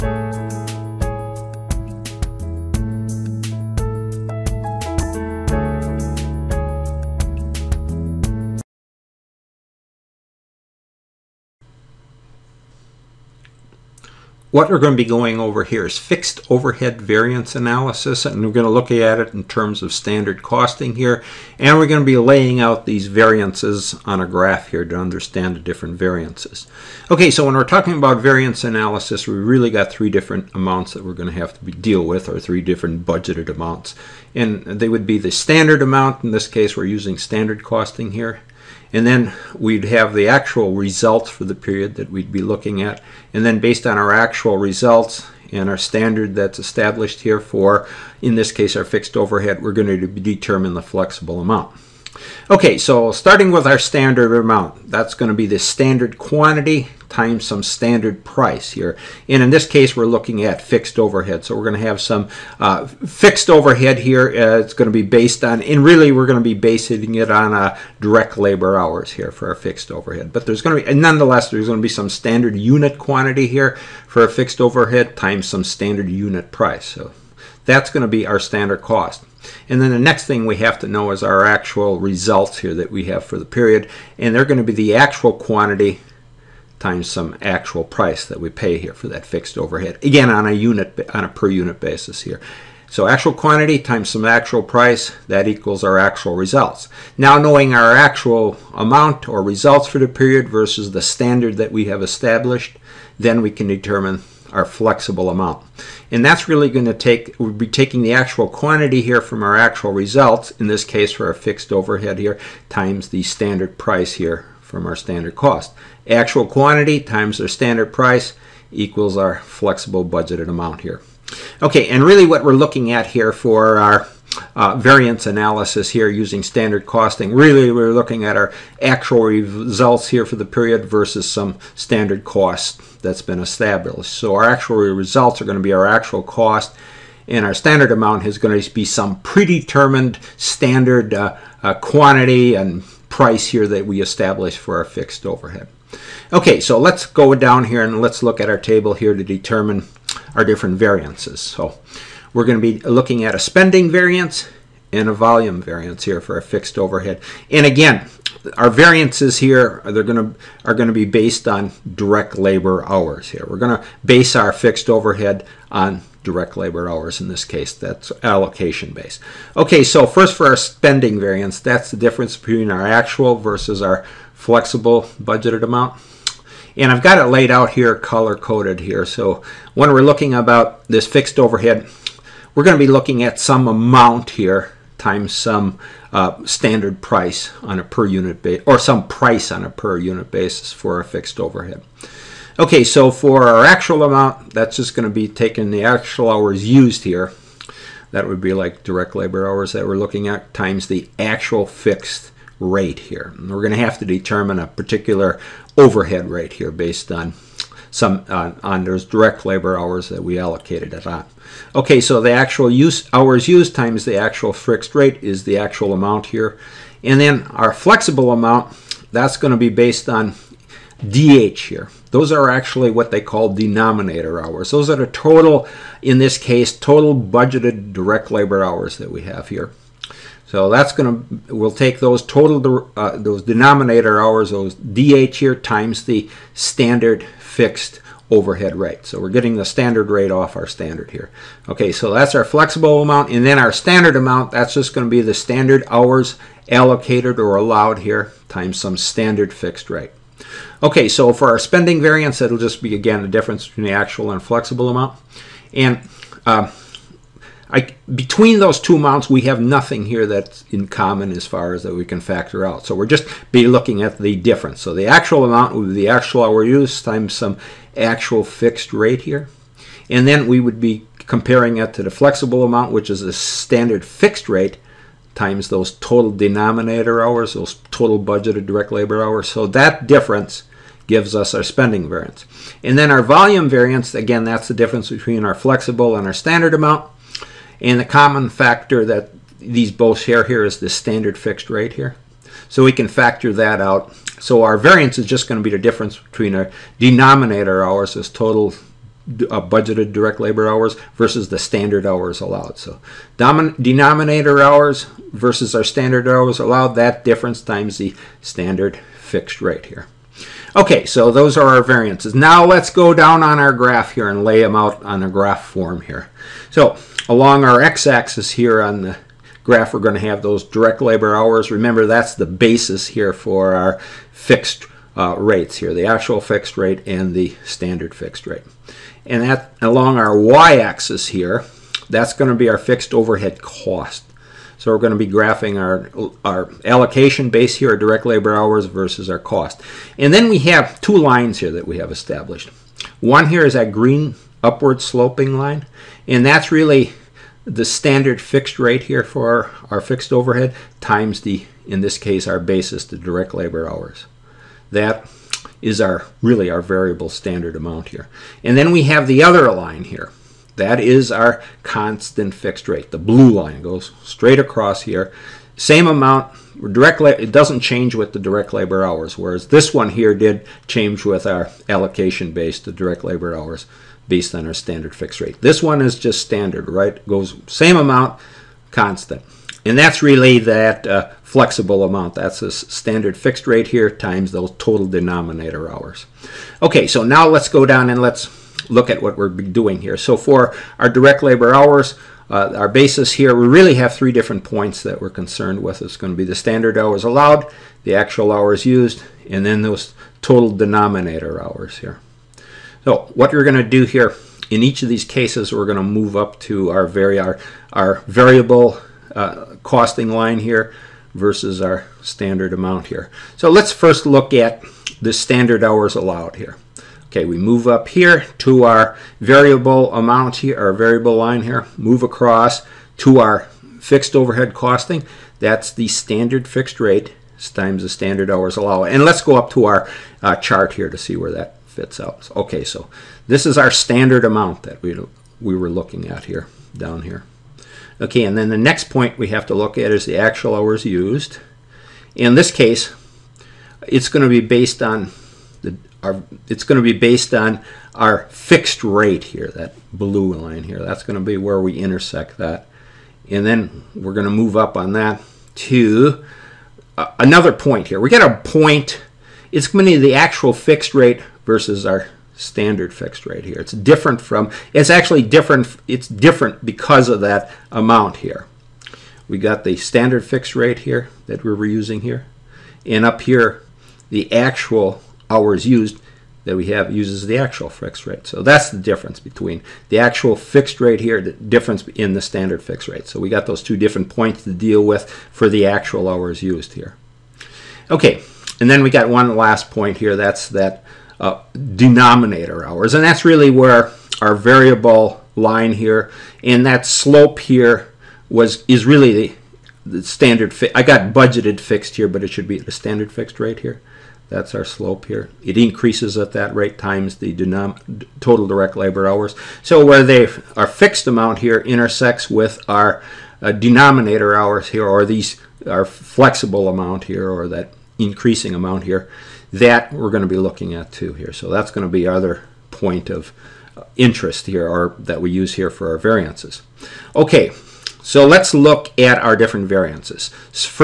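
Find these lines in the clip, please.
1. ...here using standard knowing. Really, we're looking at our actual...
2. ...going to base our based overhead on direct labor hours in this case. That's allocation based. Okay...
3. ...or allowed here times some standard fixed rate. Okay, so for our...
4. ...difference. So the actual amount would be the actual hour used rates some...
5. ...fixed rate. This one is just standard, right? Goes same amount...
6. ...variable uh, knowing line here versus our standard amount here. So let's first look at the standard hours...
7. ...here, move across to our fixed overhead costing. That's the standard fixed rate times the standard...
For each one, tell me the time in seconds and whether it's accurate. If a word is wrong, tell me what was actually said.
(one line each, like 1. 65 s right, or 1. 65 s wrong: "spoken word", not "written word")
1. 125 s wrong: "costing", not "knowing"
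2. 163 s wrong: "fixed", not "based"
3. 247 s right
4. 264 s wrong: "times", not "rates"
5. 375 s right
6. 408 s wrong: "costing", not "knowing"
7. 421 s right.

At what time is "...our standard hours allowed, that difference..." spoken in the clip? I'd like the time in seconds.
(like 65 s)
305 s.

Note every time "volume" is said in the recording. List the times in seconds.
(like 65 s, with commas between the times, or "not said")
155 s, 283 s.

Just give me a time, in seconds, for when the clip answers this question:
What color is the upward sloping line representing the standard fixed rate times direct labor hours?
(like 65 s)
343 s.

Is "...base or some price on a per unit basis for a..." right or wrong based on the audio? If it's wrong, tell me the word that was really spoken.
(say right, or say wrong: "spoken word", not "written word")
right.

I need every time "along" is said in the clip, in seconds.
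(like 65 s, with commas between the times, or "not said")
317 s, 329 s.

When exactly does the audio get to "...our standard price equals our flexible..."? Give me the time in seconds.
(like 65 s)
117 s.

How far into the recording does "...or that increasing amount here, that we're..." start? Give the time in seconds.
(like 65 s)
517 s.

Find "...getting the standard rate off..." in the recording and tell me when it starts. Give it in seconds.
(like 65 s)
239 s.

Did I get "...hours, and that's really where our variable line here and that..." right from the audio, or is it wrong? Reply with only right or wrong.
right.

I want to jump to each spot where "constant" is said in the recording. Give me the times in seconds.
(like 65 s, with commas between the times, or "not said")
361 s, 378 s.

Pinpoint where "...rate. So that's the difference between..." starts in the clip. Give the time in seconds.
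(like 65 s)
478 s.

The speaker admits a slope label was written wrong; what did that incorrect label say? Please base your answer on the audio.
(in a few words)
Budgeted fixed.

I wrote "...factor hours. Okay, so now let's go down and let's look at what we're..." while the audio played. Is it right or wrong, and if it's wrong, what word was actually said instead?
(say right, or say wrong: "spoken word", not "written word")
wrong: "denominator", not "factor".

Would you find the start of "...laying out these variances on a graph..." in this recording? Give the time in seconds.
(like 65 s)
22 s.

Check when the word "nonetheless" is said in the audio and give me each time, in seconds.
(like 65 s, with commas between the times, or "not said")
70 s.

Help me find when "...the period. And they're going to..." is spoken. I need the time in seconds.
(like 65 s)
83 s.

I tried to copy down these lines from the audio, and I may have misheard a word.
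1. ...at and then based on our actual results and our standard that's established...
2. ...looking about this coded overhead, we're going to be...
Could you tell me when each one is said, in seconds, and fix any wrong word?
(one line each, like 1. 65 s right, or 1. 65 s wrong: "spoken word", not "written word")
1. 42 s right
2. 180 s wrong: "fixed", not "coded".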